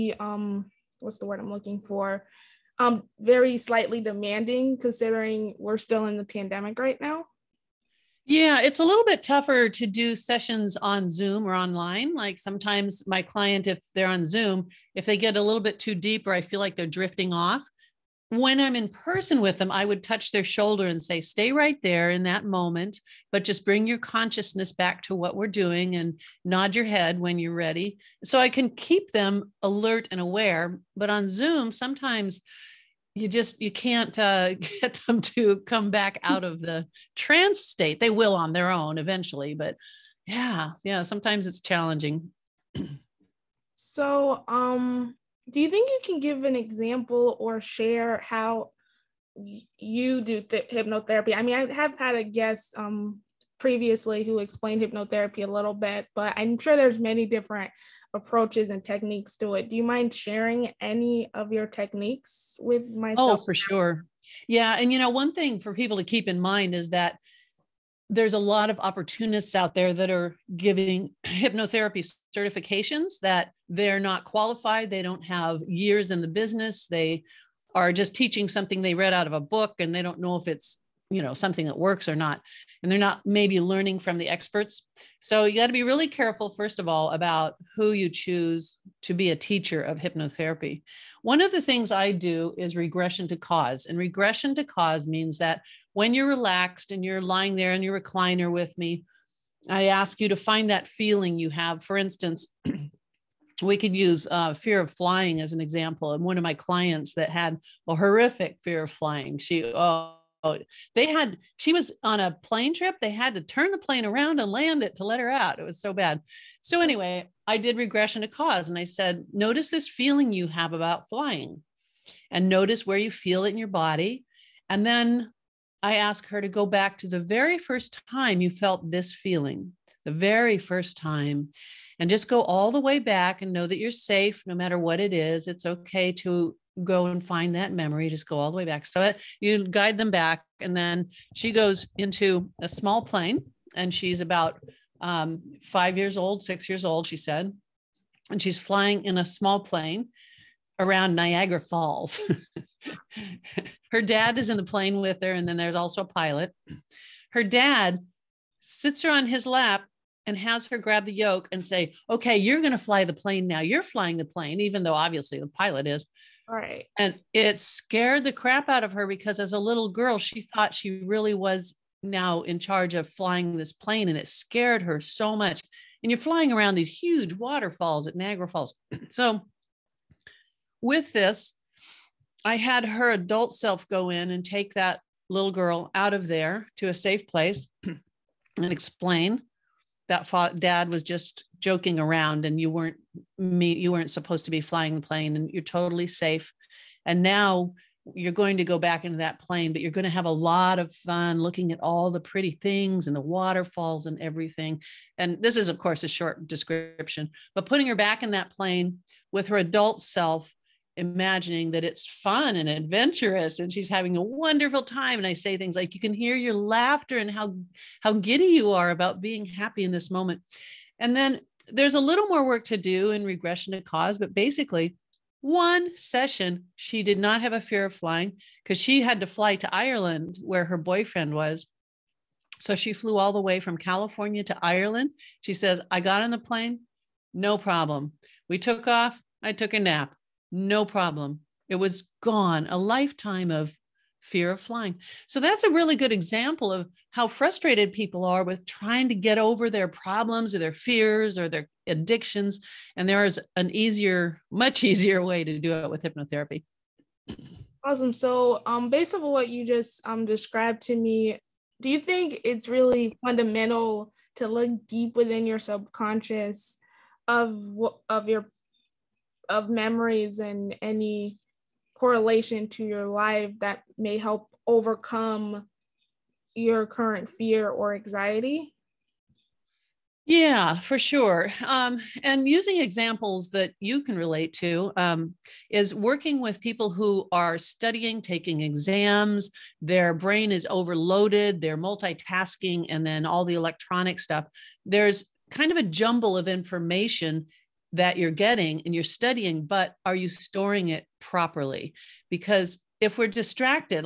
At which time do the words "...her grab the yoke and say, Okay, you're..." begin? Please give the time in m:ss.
2:40.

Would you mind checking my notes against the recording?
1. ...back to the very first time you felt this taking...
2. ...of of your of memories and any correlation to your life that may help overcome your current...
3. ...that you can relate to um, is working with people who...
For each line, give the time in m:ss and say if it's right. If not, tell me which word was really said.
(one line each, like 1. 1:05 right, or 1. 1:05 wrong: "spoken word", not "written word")
1. 2:06 wrong: "feeling", not "taking"
2. 4:27 right
3. 4:43 right.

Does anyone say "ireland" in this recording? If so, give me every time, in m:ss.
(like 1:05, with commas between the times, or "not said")
3:49, 3:54.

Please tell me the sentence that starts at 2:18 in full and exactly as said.
So uh, you guide them back.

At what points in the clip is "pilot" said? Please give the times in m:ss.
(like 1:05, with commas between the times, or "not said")
2:36, 2:45.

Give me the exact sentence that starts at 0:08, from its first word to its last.
Yeah, it's a little bit tougher to do sessions on Zoom or online.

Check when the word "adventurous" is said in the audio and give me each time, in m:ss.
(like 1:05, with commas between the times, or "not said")
3:32.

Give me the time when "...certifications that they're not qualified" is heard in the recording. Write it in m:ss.
1:12.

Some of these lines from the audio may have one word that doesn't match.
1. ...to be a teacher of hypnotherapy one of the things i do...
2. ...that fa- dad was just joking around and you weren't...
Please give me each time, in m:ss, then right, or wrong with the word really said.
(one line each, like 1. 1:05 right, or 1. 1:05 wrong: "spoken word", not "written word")
1. 1:29 right
2. 3:10 right.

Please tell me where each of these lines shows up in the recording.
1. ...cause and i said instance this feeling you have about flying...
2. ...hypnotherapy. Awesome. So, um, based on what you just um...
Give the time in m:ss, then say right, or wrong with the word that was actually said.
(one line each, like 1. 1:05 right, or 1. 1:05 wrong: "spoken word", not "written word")
1. 1:58 wrong: "notice", not "instance"
2. 4:16 right.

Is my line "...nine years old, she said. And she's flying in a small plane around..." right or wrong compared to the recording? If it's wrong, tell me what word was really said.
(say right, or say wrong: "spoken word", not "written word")
wrong: "six", not "nine".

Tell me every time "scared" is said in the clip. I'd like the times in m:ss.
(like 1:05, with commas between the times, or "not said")
2:47, 2:54.